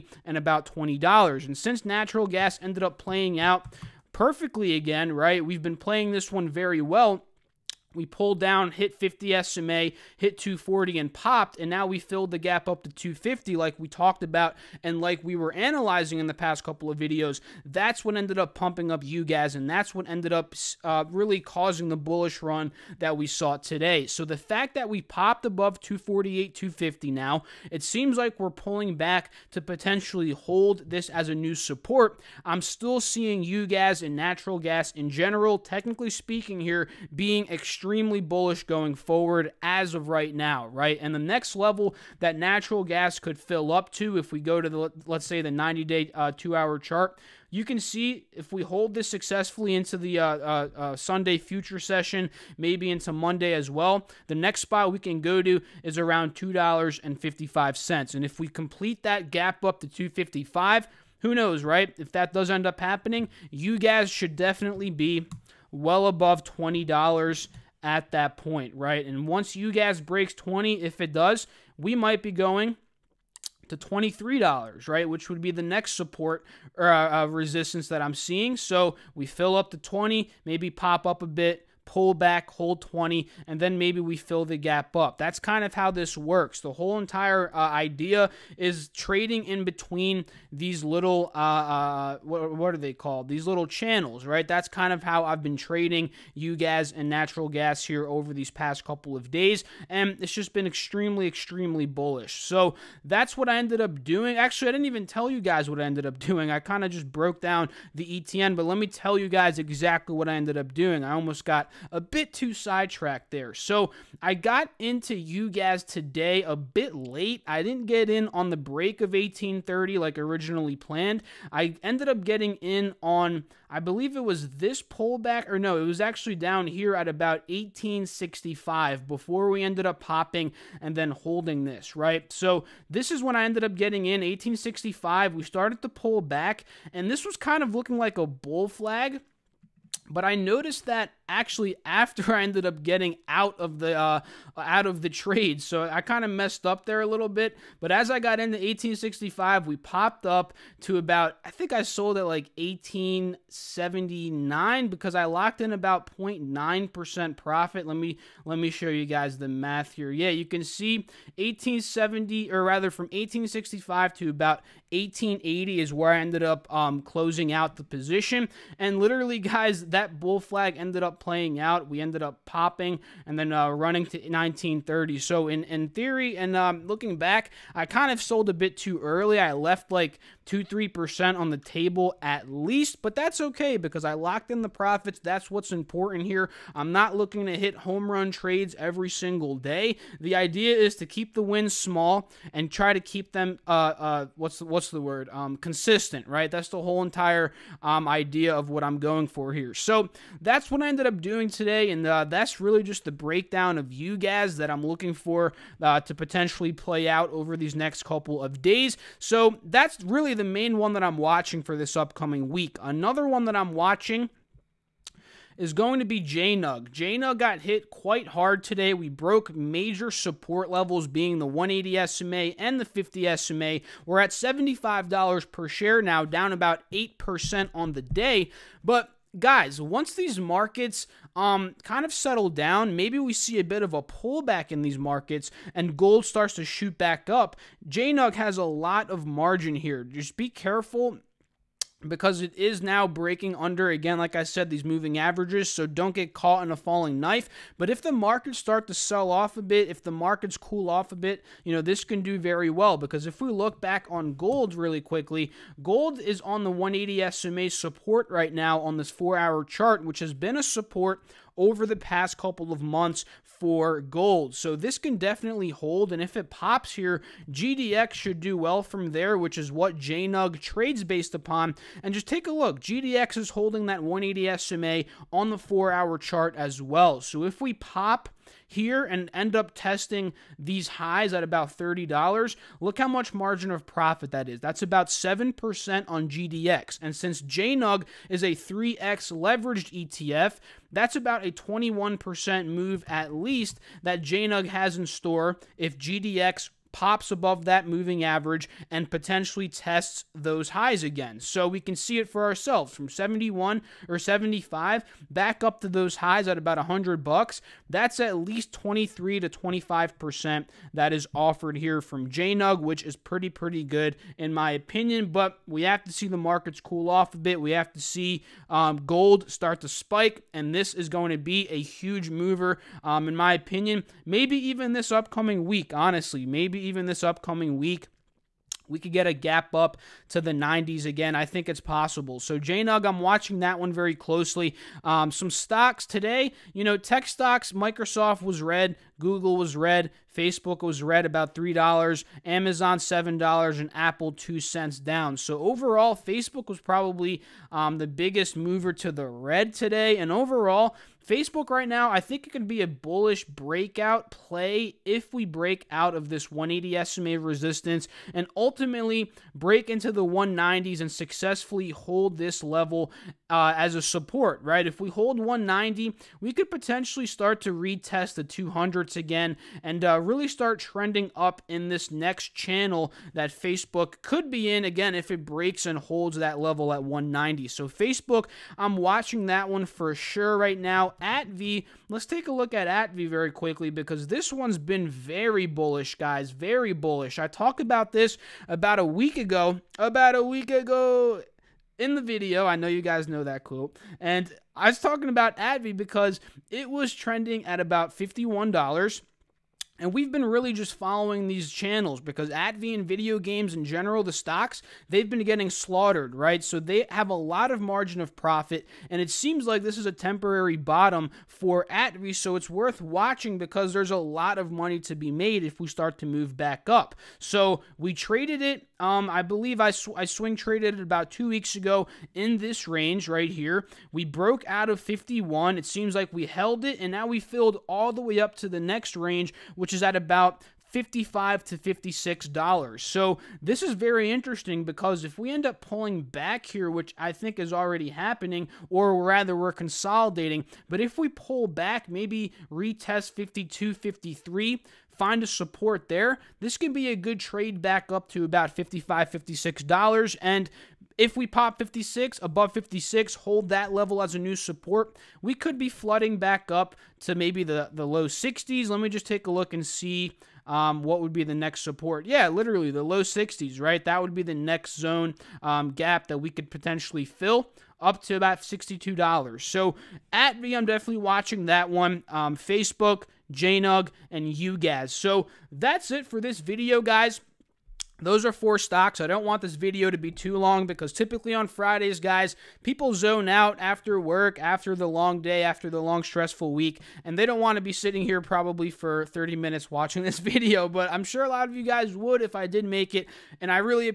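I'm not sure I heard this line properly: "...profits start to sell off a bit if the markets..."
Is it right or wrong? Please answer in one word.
wrong.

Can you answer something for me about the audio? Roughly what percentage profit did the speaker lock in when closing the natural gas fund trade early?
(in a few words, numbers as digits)
0.9%.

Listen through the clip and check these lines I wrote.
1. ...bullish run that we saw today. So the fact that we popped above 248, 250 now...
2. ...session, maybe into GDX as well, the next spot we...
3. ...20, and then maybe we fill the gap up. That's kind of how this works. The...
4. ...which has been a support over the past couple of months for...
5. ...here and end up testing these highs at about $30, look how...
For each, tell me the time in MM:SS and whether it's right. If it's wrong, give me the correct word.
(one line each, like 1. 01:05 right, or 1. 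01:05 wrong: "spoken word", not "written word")
1. 00:21 right
2. 00:51 wrong: "Monday", not "GDX"
3. 01:22 right
4. 04:20 right
5. 04:38 right.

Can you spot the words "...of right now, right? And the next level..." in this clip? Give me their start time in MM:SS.
00:39.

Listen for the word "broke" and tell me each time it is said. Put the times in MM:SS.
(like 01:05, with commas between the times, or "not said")
01:47, 03:39, 07:04.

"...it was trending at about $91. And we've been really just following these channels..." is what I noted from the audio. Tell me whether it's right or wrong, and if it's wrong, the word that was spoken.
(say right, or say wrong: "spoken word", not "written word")
wrong: "51", not "91".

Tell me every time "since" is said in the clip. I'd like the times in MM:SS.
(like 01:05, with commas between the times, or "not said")
00:01, 04:47.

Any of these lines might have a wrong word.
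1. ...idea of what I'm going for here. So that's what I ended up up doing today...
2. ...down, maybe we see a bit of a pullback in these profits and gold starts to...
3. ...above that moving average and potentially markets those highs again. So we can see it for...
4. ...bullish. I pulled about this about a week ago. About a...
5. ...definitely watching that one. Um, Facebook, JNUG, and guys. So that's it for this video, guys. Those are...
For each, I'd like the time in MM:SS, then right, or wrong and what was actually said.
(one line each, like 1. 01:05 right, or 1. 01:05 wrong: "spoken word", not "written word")
1. 03:18 right
2. 03:52 wrong: "markets", not "profits"
3. 04:57 wrong: "tests", not "markets"
4. 06:26 wrong: "talked", not "pulled"
5. 07:50 right.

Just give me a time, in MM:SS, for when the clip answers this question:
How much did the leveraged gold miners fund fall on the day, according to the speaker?
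03:46.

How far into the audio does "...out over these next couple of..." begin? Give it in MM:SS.
03:27.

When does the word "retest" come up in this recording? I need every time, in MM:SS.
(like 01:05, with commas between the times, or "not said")
06:07, 07:22.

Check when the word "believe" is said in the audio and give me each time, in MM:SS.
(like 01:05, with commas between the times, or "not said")
02:03, 06:59.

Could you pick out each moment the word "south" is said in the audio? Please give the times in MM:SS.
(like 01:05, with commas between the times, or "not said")
not said.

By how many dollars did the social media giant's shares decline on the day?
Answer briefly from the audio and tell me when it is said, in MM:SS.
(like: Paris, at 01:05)
$3, at 05:41.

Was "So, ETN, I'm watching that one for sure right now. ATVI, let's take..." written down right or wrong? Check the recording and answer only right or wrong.
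wrong.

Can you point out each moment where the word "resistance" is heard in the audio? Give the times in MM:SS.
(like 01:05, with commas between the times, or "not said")
01:17, 05:57.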